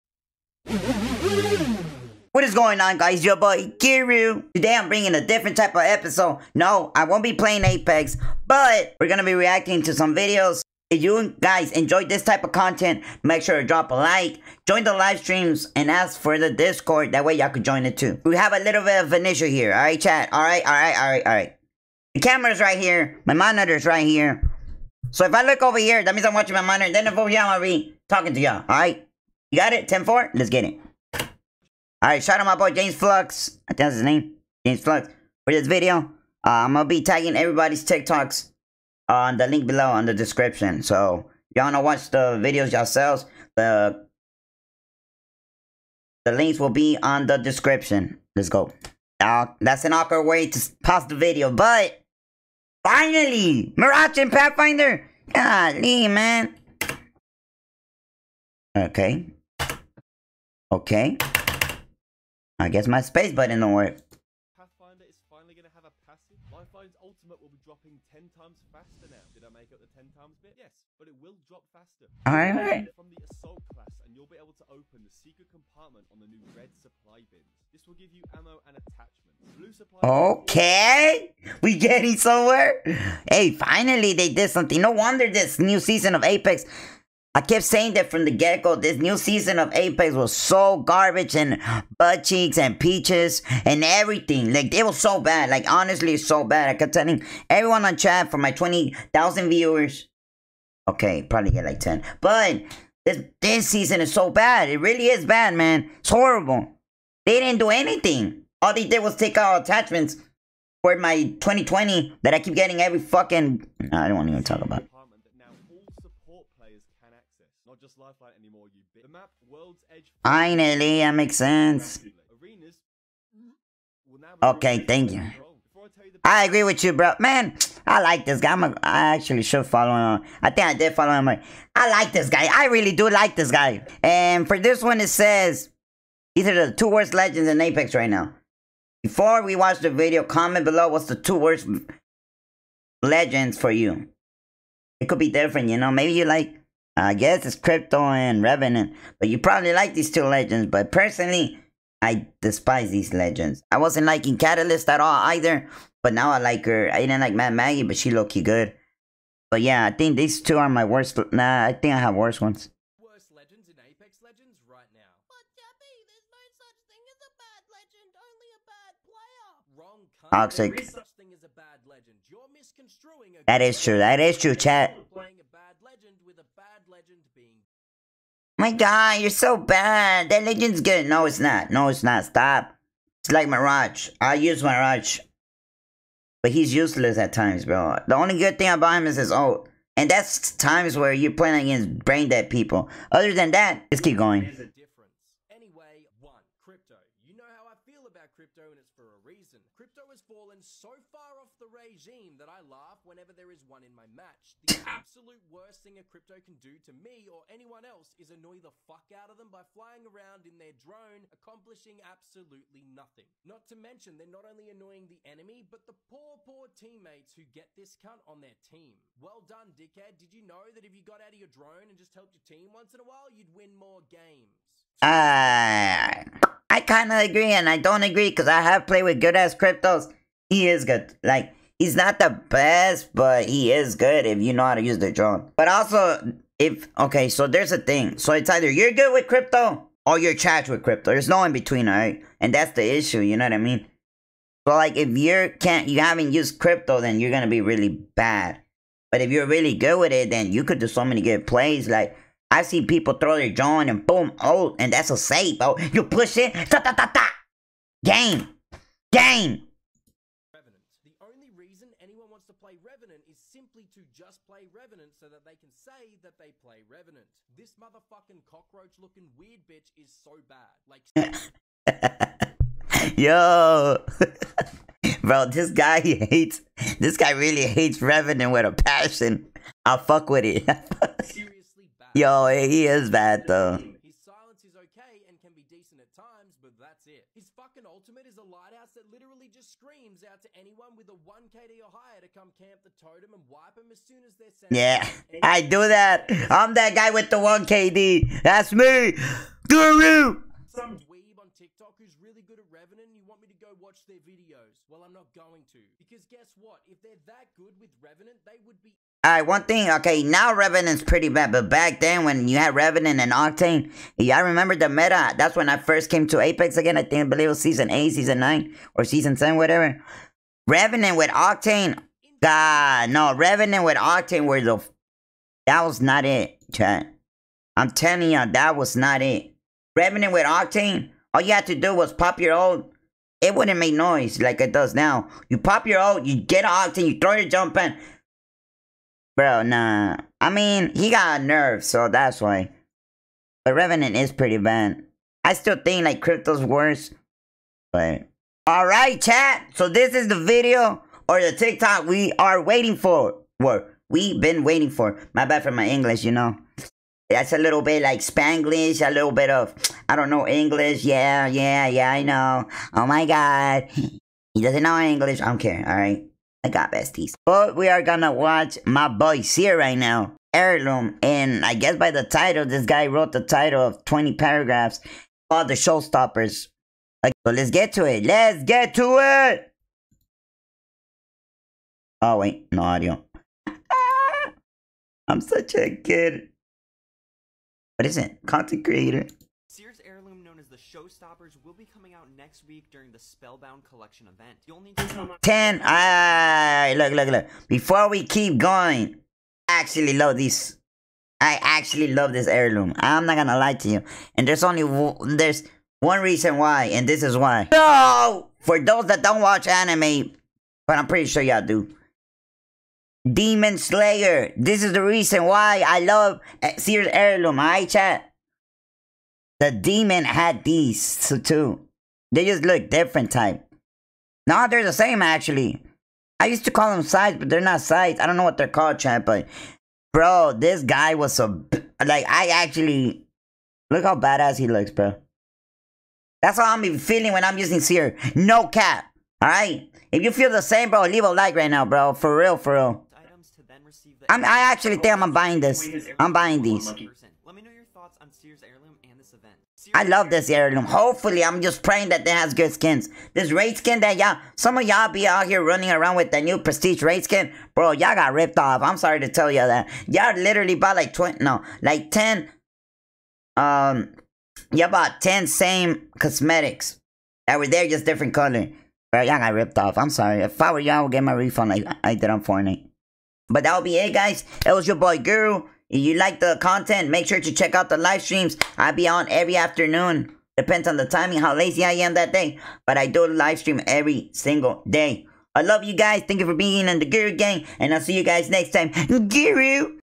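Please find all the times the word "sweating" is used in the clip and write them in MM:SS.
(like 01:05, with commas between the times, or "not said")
not said.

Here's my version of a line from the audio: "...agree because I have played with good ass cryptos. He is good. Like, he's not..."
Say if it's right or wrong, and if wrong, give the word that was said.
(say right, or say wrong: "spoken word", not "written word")
right.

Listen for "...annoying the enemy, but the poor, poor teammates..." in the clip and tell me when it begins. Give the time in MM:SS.
03:34.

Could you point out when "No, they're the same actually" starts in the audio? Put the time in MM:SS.
07:04.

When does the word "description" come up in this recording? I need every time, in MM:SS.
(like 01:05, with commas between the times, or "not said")
00:40, 00:47.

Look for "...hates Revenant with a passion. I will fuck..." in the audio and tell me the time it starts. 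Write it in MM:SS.
04:37.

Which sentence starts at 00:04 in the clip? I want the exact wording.
Today I'm bringing a different type of episode.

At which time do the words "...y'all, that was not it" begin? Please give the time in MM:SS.
05:28.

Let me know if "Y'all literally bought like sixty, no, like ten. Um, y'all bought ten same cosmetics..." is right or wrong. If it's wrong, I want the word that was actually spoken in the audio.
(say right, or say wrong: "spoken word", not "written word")
wrong: "twenty", not "sixty".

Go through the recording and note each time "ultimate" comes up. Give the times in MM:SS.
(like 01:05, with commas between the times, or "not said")
01:07, 04:47.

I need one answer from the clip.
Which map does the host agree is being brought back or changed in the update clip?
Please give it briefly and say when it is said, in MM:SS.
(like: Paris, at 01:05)
World's Edge, at 01:59.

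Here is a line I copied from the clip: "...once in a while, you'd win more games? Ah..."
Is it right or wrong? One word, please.
right.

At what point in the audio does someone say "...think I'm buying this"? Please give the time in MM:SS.
07:24.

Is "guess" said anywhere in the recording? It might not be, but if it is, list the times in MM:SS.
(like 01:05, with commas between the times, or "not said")
01:02, 02:27, 05:06, 06:11.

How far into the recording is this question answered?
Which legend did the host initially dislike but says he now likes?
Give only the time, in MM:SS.
02:34.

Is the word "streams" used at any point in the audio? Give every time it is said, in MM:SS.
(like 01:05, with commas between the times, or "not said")
00:15, 07:58, 08:03.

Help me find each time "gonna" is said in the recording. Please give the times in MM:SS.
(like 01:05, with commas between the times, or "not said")
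00:09, 00:27, 04:07, 06:08, 06:43.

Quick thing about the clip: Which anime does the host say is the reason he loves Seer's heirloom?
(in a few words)
Demon Slayer.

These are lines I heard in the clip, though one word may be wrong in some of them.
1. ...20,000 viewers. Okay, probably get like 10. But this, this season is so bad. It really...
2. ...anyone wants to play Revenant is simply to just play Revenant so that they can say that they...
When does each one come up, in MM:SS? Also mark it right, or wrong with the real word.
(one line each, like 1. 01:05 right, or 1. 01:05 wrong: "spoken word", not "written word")
1. 01:38 right
2. 04:22 right.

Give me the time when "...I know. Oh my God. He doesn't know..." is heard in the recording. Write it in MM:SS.
06:02.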